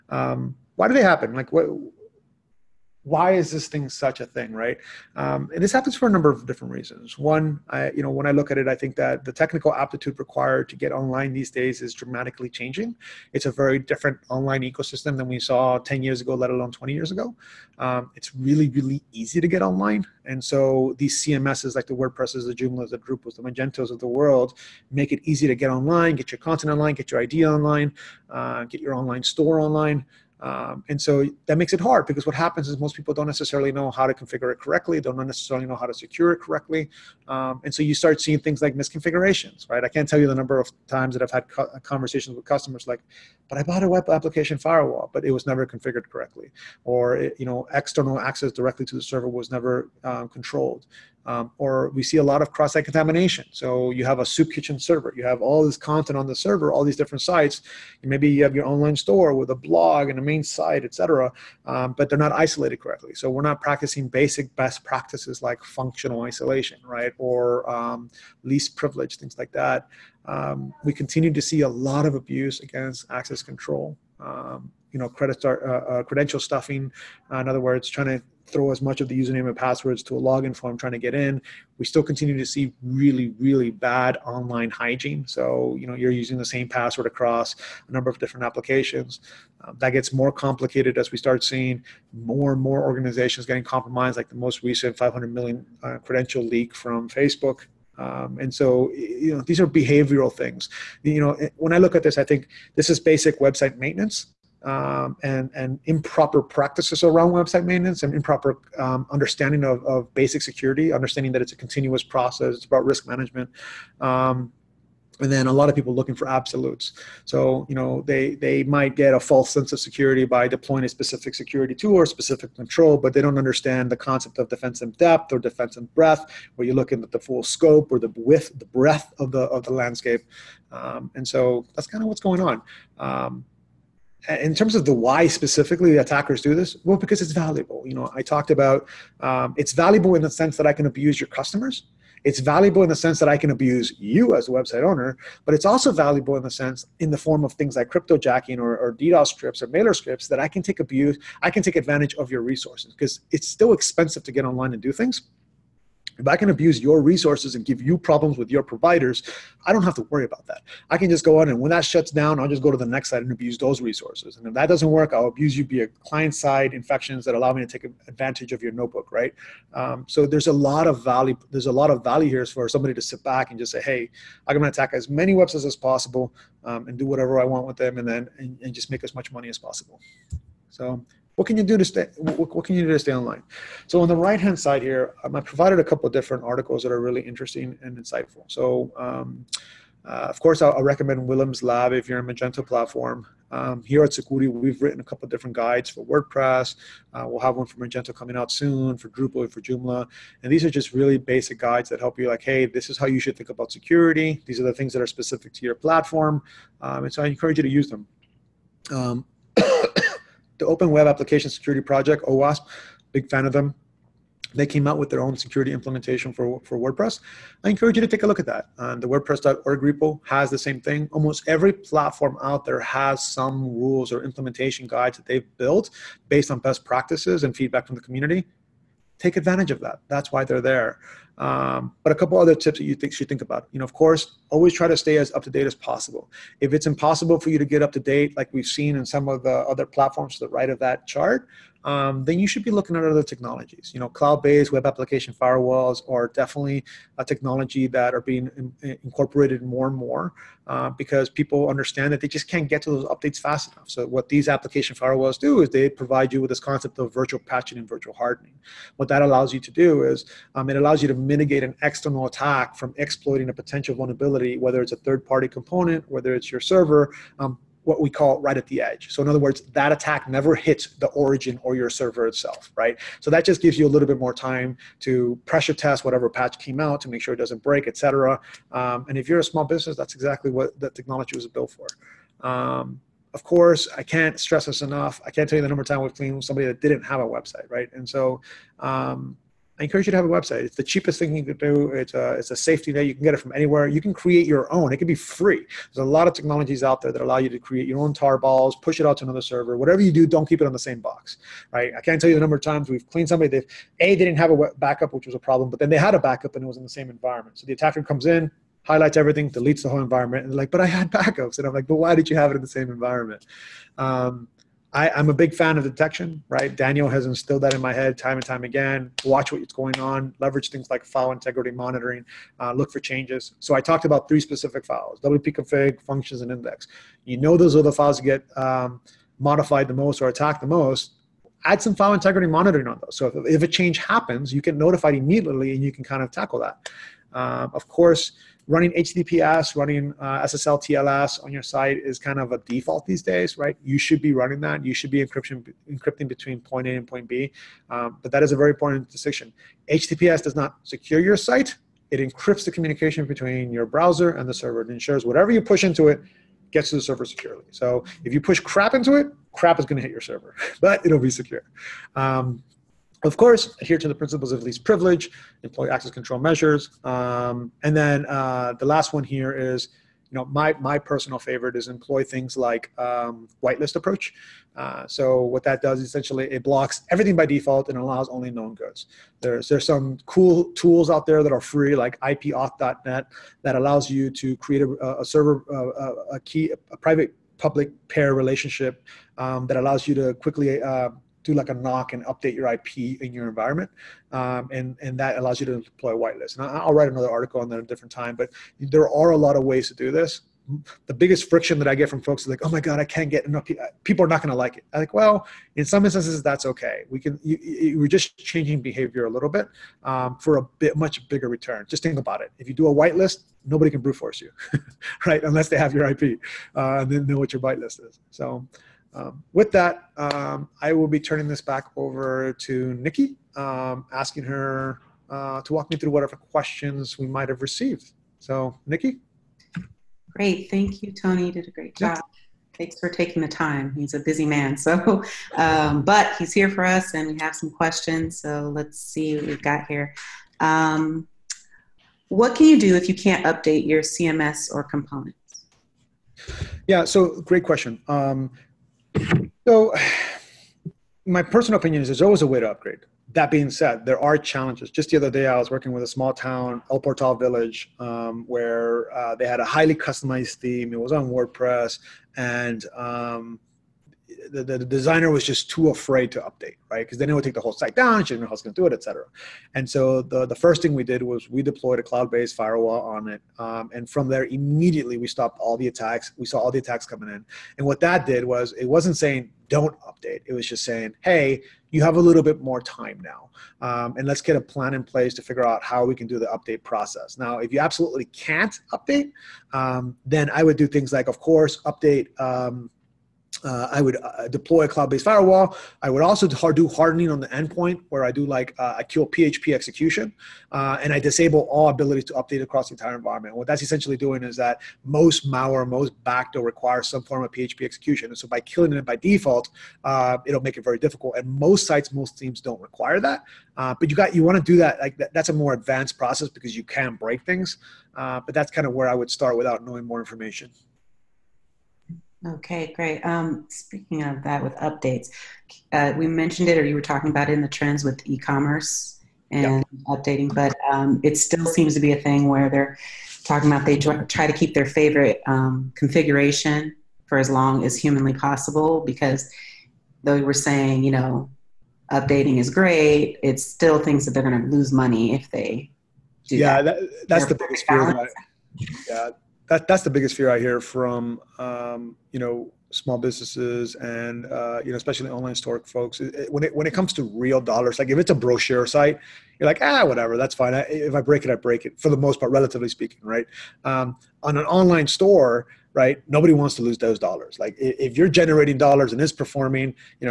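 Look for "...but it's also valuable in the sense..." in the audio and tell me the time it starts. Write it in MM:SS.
02:25.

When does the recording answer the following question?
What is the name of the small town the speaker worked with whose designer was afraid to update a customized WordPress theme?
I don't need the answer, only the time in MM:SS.
07:36.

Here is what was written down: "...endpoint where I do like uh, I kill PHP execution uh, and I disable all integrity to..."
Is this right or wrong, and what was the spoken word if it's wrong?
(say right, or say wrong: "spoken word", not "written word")
wrong: "ability", not "integrity".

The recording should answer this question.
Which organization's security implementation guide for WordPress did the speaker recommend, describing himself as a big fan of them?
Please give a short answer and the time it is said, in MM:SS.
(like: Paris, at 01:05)
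OWASP, at 03:32.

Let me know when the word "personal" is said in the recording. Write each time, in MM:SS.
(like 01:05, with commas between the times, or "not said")
06:10, 07:31.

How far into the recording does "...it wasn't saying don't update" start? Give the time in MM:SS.
07:58.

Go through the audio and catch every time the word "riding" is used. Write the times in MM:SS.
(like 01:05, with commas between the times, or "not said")
not said.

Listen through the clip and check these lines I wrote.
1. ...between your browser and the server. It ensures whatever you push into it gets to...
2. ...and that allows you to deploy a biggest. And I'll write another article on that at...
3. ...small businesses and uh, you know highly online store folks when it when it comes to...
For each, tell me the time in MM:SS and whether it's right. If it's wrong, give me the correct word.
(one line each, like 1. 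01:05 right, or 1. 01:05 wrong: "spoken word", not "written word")
1. 05:53 right
2. 06:35 wrong: "whitelist", not "biggest"
3. 09:12 wrong: "especially", not "highly".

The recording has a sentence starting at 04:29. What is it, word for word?
So in other words, that attack never hits the origin or your server itself, right?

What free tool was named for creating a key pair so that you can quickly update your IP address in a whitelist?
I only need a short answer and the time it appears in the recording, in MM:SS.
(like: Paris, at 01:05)
IPauth.net, at 06:22.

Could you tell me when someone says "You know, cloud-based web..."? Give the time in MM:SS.
04:03.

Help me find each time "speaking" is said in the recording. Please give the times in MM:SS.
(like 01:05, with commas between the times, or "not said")
08:43, 09:22.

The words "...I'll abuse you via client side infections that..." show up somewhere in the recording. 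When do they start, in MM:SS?
02:45.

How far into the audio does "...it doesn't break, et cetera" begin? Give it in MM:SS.
04:37.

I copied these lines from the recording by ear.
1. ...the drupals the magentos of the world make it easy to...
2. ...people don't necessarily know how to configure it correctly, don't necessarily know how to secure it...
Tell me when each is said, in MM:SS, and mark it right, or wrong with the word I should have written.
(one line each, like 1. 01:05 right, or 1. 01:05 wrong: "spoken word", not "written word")
1. 00:22 right
2. 00:32 right.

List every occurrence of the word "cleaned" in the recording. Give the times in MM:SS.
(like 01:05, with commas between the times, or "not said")
04:46, 05:03.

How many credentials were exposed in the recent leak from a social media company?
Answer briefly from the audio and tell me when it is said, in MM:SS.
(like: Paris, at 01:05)
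500 million, at 01:34.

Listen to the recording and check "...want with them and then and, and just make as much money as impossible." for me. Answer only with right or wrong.
wrong.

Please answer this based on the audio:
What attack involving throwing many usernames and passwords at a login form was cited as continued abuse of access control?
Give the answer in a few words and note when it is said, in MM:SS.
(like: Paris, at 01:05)
credential stuffing, at 01:16.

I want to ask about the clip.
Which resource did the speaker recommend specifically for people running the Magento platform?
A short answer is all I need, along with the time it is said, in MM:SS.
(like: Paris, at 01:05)
Willem's Lab, at 03:11.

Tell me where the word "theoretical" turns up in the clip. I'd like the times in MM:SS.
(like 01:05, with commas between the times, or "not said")
not said.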